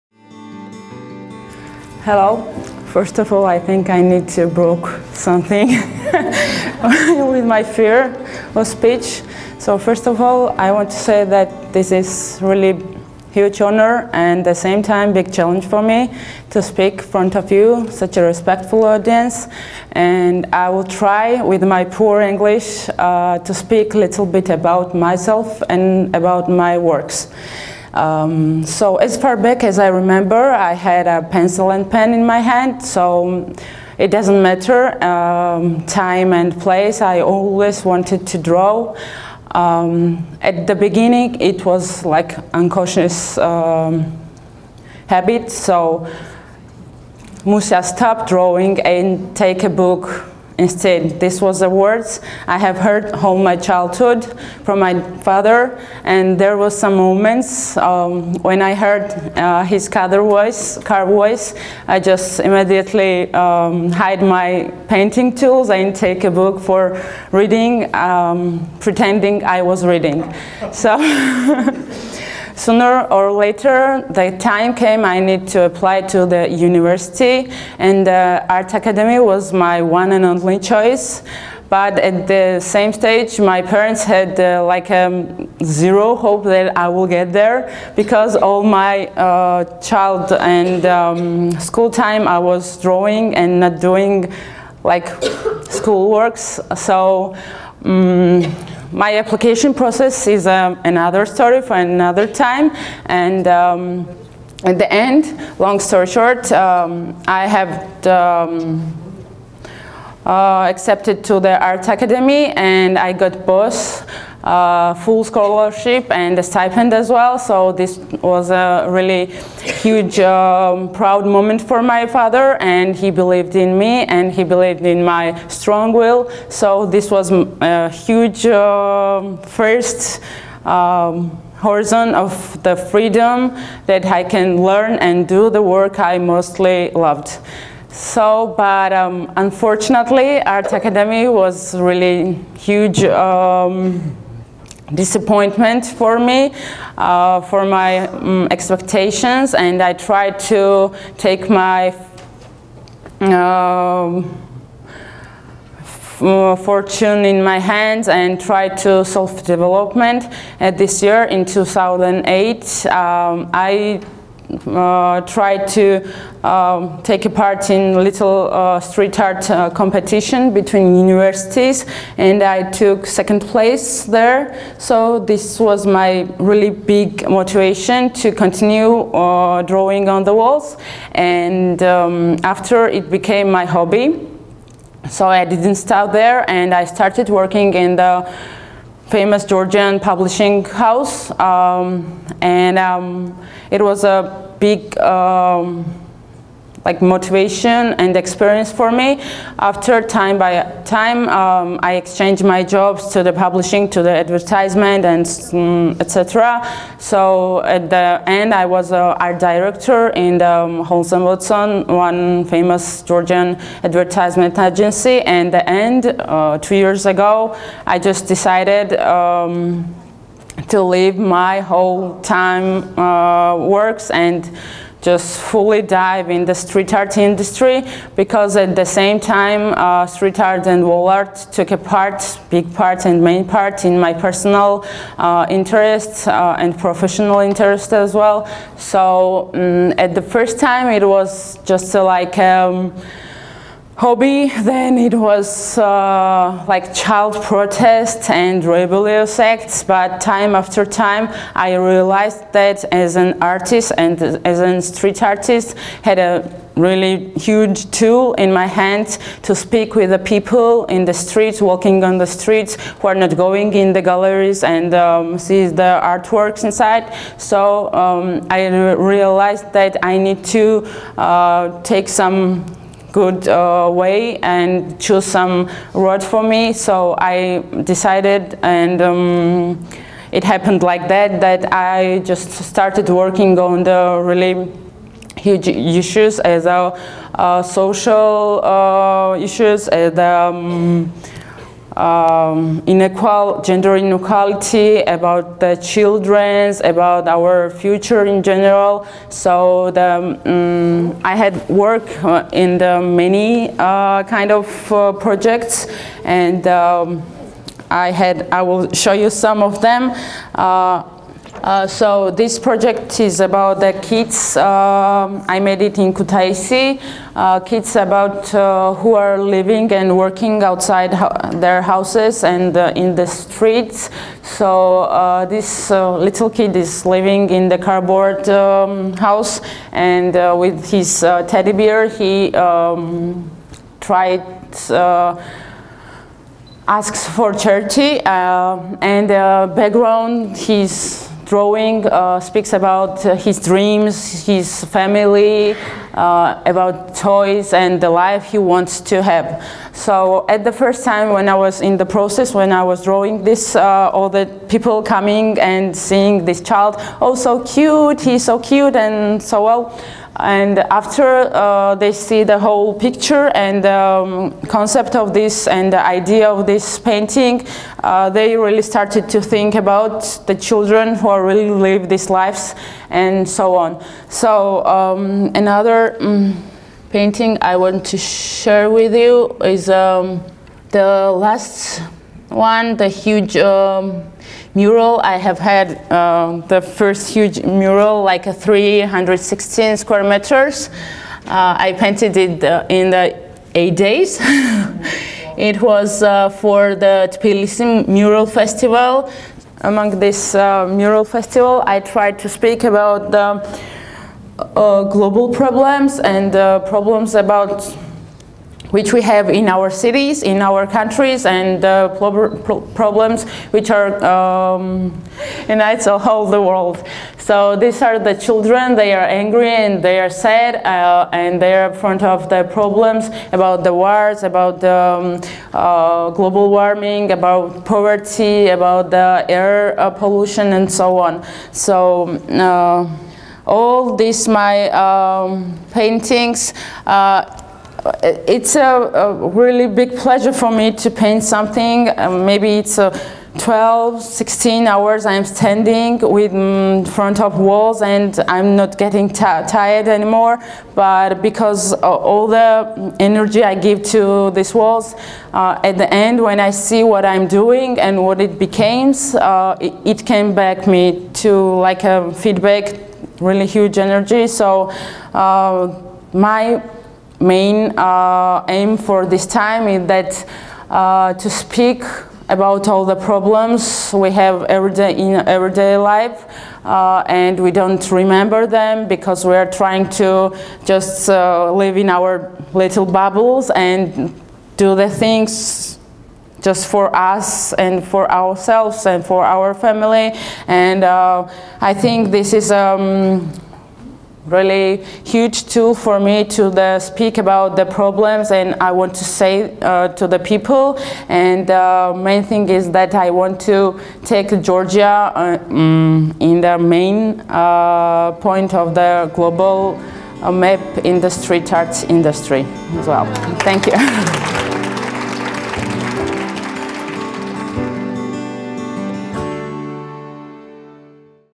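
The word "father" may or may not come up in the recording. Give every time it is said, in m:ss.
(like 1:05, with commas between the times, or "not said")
0:55, 2:02.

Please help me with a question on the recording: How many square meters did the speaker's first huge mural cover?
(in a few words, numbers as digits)
316.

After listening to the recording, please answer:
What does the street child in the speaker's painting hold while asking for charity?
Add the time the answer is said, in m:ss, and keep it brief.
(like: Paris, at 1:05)
Teddy bear, at 5:31.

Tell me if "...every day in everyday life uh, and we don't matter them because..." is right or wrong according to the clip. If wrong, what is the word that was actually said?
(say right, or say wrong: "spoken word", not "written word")
wrong: "remember", not "matter".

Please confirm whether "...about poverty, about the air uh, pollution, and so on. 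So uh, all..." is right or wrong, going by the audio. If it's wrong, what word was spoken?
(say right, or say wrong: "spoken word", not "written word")
right.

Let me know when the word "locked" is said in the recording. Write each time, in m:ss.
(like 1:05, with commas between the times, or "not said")
not said.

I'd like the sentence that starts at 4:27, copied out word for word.
So um, I re realized that I need to uh, take some good uh, way and choose some road for me.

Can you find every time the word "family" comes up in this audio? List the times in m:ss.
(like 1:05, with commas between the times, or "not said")
5:44, 8:09.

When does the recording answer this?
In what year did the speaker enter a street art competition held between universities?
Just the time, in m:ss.
2:41.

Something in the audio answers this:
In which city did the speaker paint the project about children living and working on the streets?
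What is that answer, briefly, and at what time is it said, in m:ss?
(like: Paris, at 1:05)
Kutaisi, at 5:16.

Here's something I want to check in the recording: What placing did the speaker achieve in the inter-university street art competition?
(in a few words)
Second place.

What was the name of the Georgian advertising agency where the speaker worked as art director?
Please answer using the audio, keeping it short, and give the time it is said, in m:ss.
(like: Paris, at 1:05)
Holson Watson, at 3:30.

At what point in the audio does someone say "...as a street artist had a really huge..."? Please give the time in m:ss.
4:14.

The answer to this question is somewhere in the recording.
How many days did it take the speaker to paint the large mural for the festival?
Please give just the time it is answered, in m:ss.
6:33.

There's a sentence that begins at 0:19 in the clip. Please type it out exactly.
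And I will try with my poor English uh, to speak a little bit about myself and about my works.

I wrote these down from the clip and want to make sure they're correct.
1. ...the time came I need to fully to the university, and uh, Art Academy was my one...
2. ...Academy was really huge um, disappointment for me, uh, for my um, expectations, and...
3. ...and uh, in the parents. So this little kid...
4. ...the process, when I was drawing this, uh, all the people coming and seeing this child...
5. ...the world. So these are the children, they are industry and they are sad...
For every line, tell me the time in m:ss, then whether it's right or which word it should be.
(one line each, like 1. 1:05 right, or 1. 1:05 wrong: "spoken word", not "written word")
1. 1:14 wrong: "apply", not "fully"
2. 2:20 right
3. 5:22 wrong: "streets", not "parents"
4. 5:51 right
5. 6:56 wrong: "angry", not "industry".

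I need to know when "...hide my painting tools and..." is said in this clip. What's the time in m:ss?
1:03.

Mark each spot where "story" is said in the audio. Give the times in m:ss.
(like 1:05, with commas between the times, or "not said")
1:41, 1:45.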